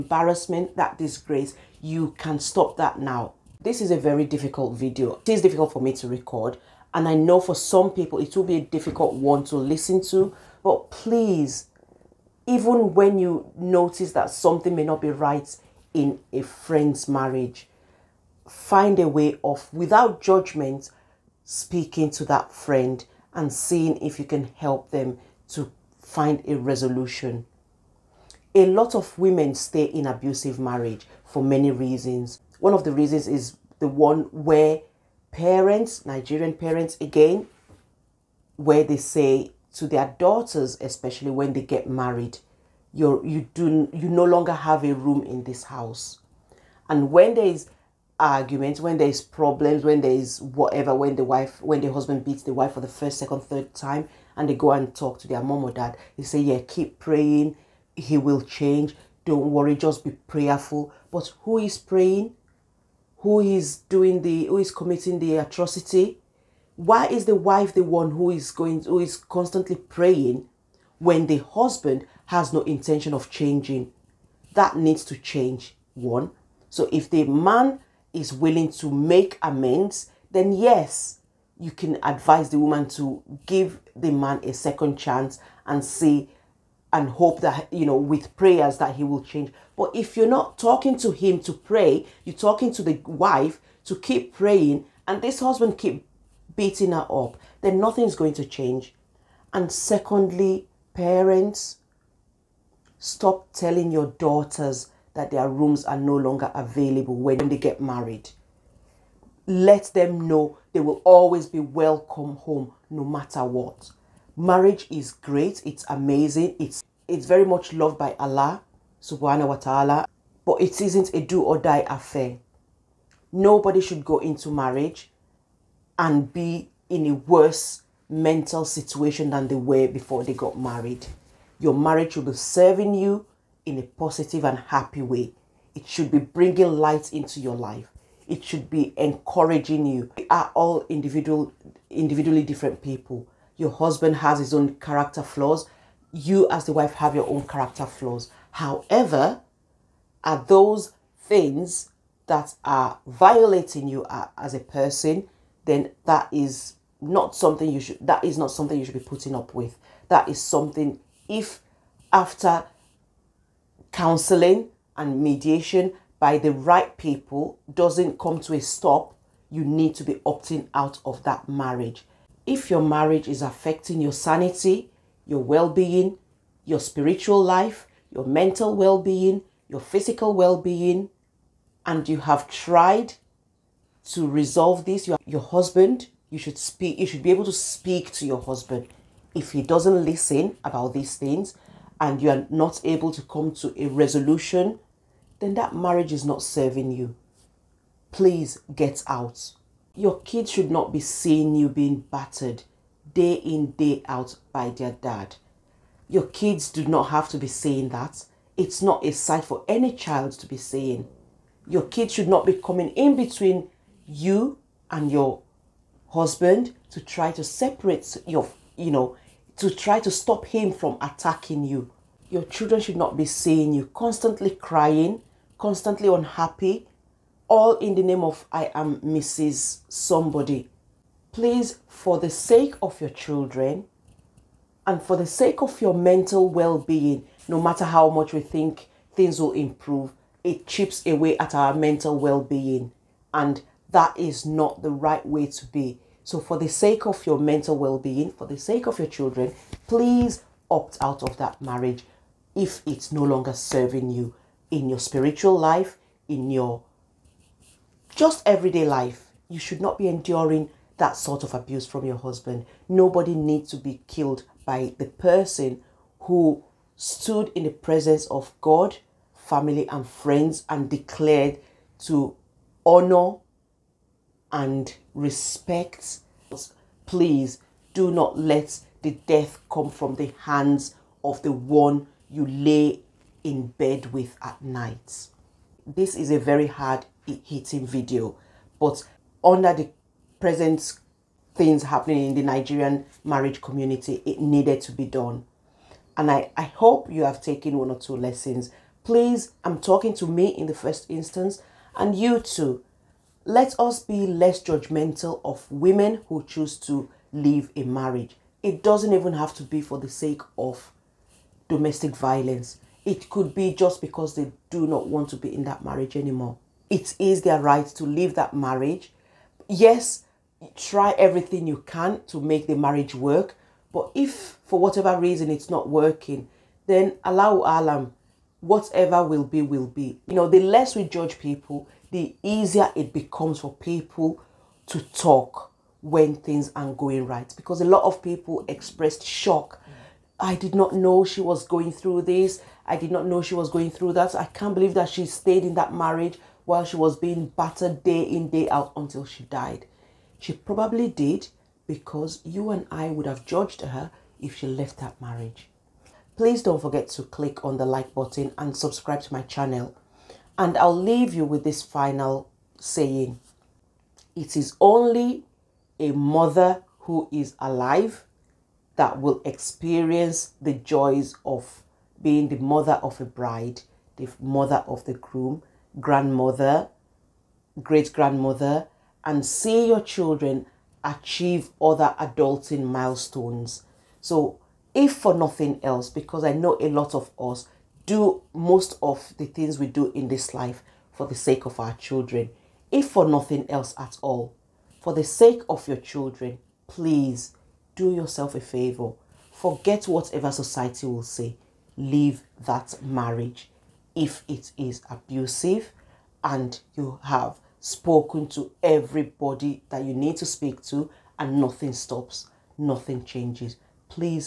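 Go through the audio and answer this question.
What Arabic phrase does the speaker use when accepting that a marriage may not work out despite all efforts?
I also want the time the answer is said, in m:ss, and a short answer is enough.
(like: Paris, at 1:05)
Allahu alam, at 5:27.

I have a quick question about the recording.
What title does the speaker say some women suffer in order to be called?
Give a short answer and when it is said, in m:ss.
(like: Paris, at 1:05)
Mrs. Somebody, at 3:49.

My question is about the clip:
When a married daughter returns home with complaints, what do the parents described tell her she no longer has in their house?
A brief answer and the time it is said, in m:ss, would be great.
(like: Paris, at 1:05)
A room, at 0:44.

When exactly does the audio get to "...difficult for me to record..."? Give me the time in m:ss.
0:05.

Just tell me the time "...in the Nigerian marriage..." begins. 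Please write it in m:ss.
4:52.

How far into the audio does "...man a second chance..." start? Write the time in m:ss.
1:24.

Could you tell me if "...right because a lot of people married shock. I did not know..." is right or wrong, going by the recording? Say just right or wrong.
wrong.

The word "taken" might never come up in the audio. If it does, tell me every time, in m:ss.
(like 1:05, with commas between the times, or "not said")
4:57.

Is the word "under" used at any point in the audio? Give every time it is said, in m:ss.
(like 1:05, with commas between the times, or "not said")
4:49.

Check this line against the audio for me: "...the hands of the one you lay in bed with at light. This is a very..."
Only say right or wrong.
wrong.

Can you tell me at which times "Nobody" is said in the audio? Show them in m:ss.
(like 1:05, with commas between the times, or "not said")
2:03, 4:22.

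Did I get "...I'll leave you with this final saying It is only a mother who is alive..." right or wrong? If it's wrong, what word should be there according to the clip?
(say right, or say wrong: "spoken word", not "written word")
right.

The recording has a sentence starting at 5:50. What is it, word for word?
She probably did because you and I would have judged her if she left that marriage.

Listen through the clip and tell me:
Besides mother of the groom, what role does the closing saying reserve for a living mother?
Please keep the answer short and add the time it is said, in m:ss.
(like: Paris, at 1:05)
Mother of a bride, at 6:12.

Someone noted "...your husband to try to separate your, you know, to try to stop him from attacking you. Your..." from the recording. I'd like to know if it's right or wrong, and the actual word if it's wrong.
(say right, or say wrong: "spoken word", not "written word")
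right.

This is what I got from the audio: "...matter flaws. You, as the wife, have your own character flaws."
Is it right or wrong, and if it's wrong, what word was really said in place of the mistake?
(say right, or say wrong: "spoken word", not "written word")
wrong: "character", not "matter".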